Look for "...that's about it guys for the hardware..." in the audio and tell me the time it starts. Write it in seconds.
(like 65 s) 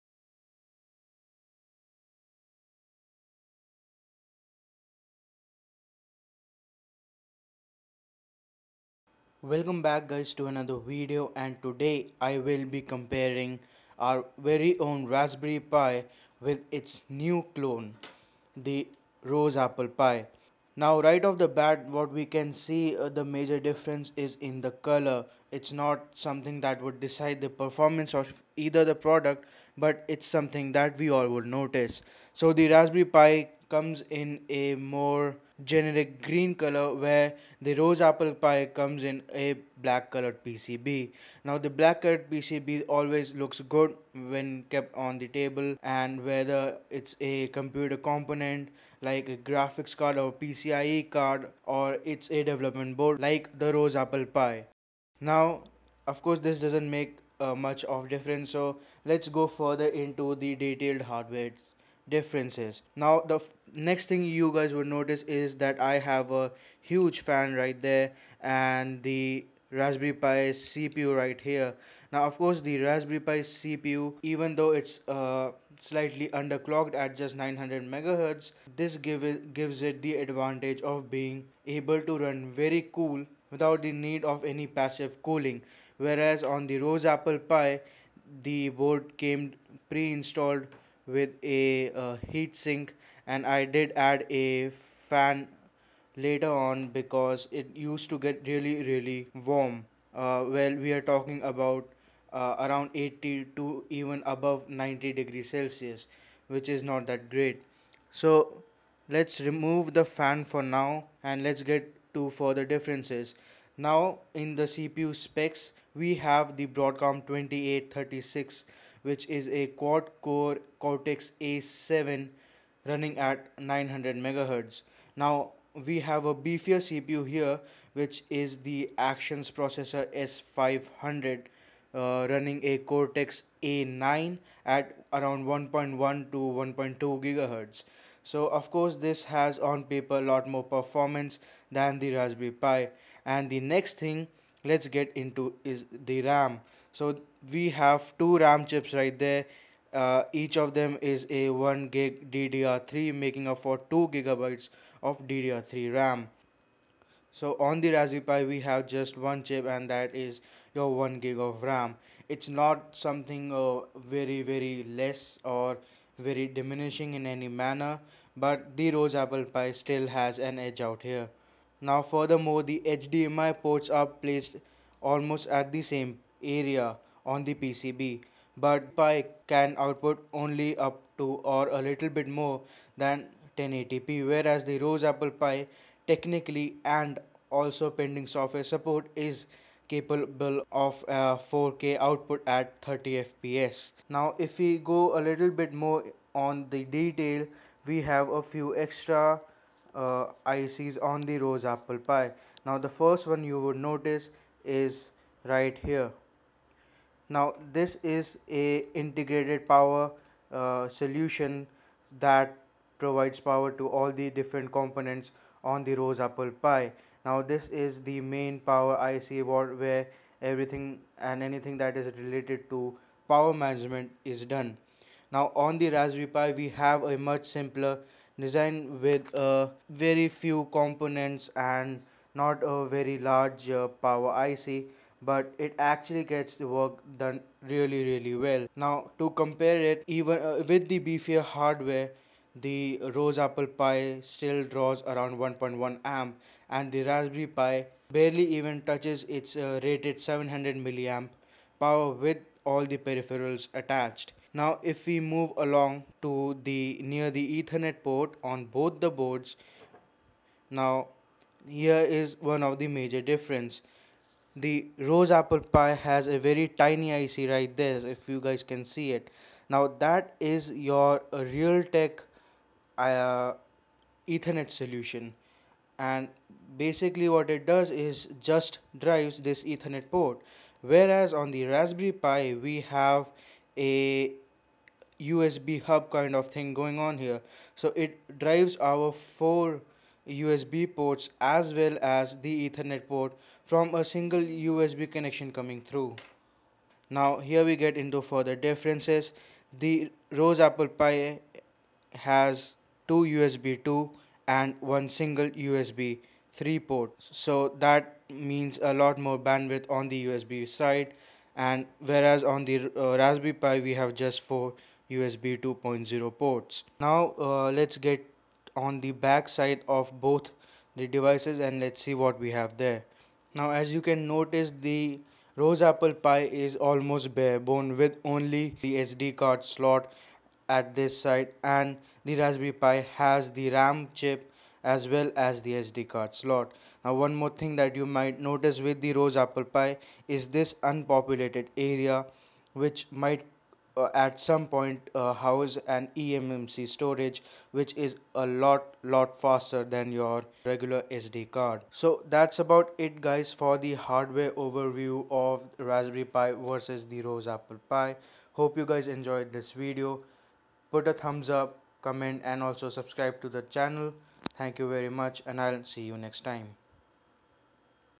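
352 s.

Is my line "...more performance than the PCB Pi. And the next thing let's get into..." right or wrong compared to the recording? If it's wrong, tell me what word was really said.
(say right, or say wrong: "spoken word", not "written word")
wrong: "Raspberry", not "PCB".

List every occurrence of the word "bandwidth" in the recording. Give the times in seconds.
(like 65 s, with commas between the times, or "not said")
309 s.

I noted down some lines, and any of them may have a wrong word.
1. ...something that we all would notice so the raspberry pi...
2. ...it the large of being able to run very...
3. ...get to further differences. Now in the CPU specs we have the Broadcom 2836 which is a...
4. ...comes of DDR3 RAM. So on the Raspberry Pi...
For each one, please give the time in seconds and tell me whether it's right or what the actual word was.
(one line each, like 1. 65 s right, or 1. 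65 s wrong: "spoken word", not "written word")
1. 30 s right
2. 79 s wrong: "advantage", not "large"
3. 111 s right
4. 154 s wrong: "gigabytes", not "comes".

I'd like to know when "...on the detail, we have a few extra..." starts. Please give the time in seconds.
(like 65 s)
196 s.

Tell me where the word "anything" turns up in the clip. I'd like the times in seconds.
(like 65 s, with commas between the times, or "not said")
221 s.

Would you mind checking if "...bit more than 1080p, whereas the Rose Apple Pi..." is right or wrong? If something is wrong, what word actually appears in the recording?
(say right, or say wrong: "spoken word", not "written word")
right.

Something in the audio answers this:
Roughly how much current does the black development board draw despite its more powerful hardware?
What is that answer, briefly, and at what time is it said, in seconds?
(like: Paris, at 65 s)
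1.1 amp, at 245 s.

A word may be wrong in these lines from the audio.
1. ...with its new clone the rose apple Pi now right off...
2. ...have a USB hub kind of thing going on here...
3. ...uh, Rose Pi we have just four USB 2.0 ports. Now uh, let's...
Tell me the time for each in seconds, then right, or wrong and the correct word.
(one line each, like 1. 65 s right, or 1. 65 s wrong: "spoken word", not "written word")
1. 16 s right
2. 282 s right
3. 312 s wrong: "Raspberry", not "Rose".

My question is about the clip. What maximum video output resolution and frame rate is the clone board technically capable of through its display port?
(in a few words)
4K at 30 FPS.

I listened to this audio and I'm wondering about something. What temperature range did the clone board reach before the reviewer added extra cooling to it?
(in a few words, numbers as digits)
80 to above 90 degrees celsius.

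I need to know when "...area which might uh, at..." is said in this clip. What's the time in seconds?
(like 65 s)
341 s.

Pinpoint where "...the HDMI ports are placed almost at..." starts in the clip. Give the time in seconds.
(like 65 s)
172 s.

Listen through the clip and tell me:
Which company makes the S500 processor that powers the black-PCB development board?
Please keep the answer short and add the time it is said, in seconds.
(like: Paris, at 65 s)
Actions, at 128 s.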